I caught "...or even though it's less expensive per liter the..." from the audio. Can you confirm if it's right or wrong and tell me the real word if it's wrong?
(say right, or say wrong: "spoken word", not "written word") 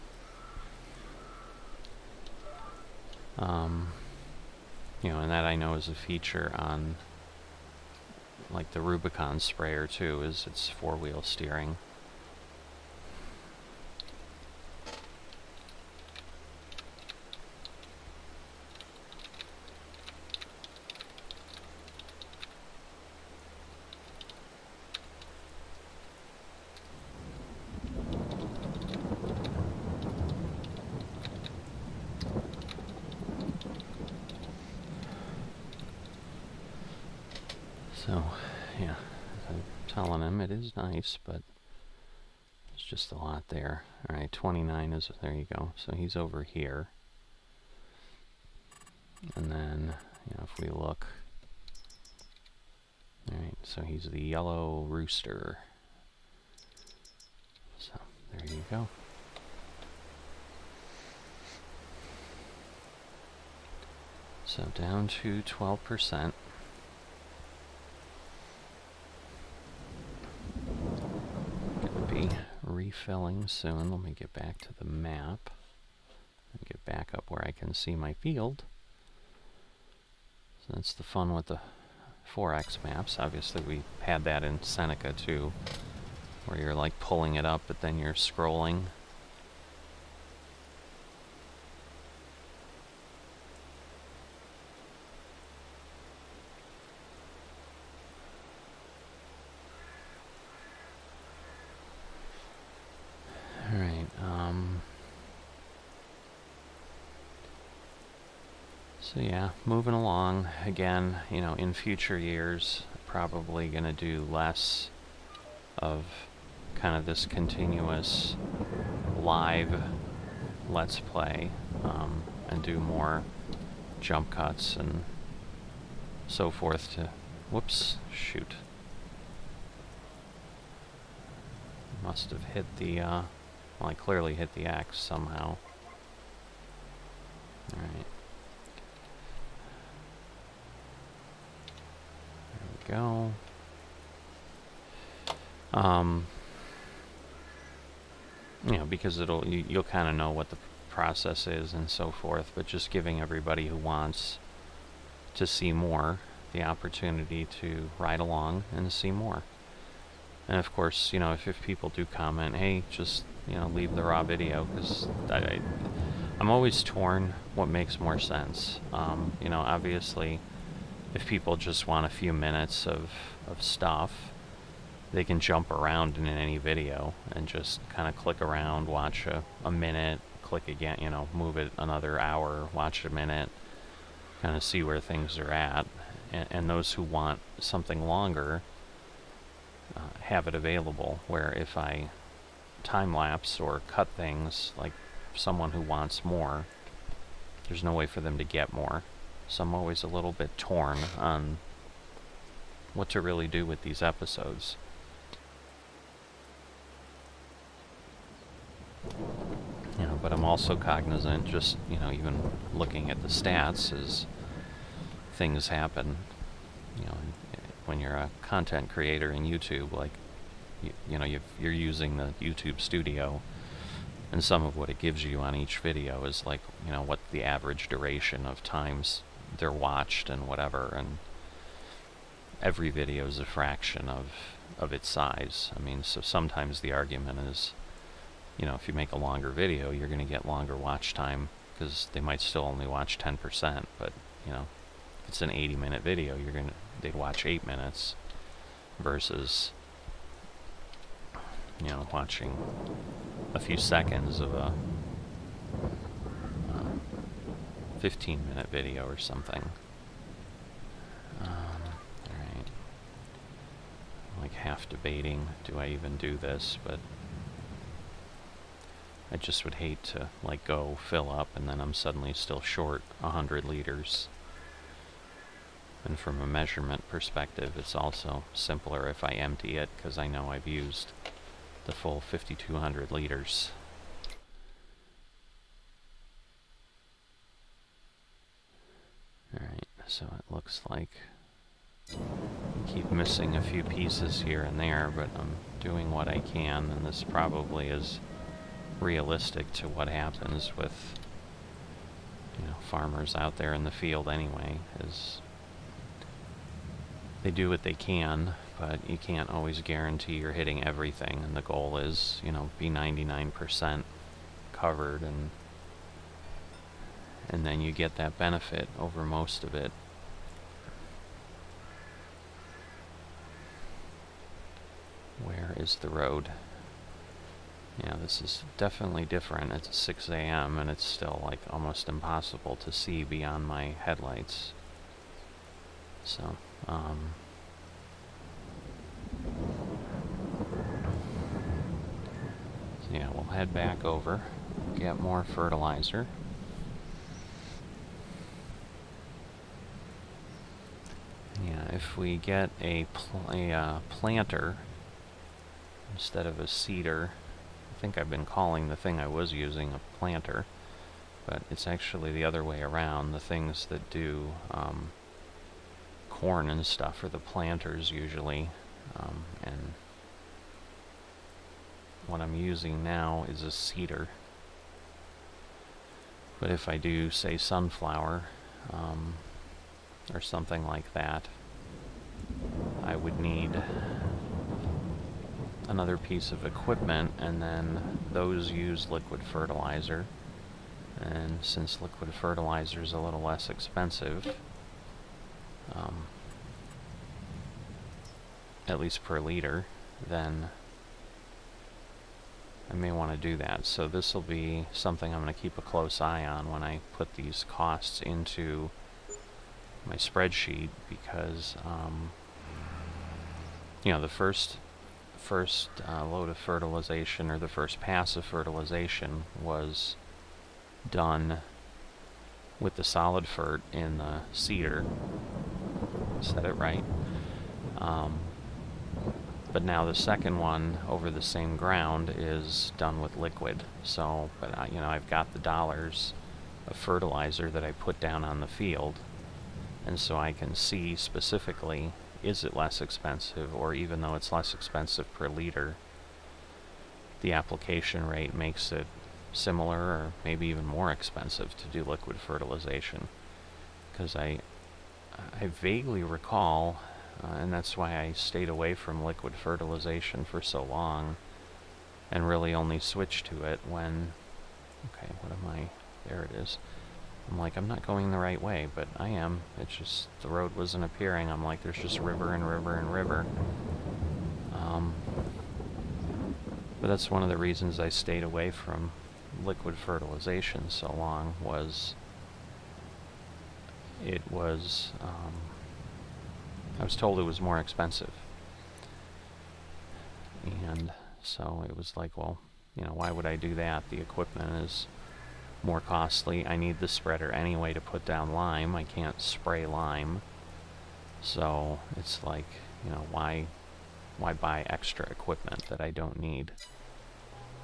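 right.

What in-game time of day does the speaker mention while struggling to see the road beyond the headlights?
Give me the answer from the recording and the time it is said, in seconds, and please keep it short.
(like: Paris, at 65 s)
6 a.m., at 329 s.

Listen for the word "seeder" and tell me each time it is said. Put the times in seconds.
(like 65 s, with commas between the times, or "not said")
356 s, 373 s, 424 s.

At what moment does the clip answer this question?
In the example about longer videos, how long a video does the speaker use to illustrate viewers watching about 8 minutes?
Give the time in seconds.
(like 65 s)
245 s.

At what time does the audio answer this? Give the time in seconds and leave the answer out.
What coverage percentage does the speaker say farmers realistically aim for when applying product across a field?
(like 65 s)
312 s.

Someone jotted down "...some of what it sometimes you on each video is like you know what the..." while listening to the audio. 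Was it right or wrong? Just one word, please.
wrong.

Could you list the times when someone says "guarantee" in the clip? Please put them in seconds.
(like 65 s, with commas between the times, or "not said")
309 s.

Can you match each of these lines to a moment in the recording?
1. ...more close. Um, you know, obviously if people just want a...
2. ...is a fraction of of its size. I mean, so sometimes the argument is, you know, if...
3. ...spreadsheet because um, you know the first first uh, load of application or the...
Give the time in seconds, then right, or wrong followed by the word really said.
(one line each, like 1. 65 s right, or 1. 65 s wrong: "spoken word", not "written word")
1. 167 s wrong: "sense", not "close"
2. 233 s right
3. 410 s wrong: "fertilization", not "application".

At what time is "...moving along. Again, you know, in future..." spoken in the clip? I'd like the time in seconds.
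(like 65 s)
109 s.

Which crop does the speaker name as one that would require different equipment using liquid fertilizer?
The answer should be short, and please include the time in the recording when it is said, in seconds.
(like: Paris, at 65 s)
Sunflower, at 377 s.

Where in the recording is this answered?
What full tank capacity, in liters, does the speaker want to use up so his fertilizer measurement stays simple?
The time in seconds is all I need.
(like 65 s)
282 s.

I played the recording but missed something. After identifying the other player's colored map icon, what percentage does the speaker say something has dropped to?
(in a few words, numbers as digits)
12%.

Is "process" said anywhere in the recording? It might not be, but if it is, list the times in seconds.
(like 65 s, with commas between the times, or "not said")
150 s.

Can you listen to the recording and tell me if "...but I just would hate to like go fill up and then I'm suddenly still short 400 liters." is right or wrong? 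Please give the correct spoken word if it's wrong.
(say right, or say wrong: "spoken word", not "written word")
wrong: "100", not "400".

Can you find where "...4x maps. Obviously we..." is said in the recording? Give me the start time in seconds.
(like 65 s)
82 s.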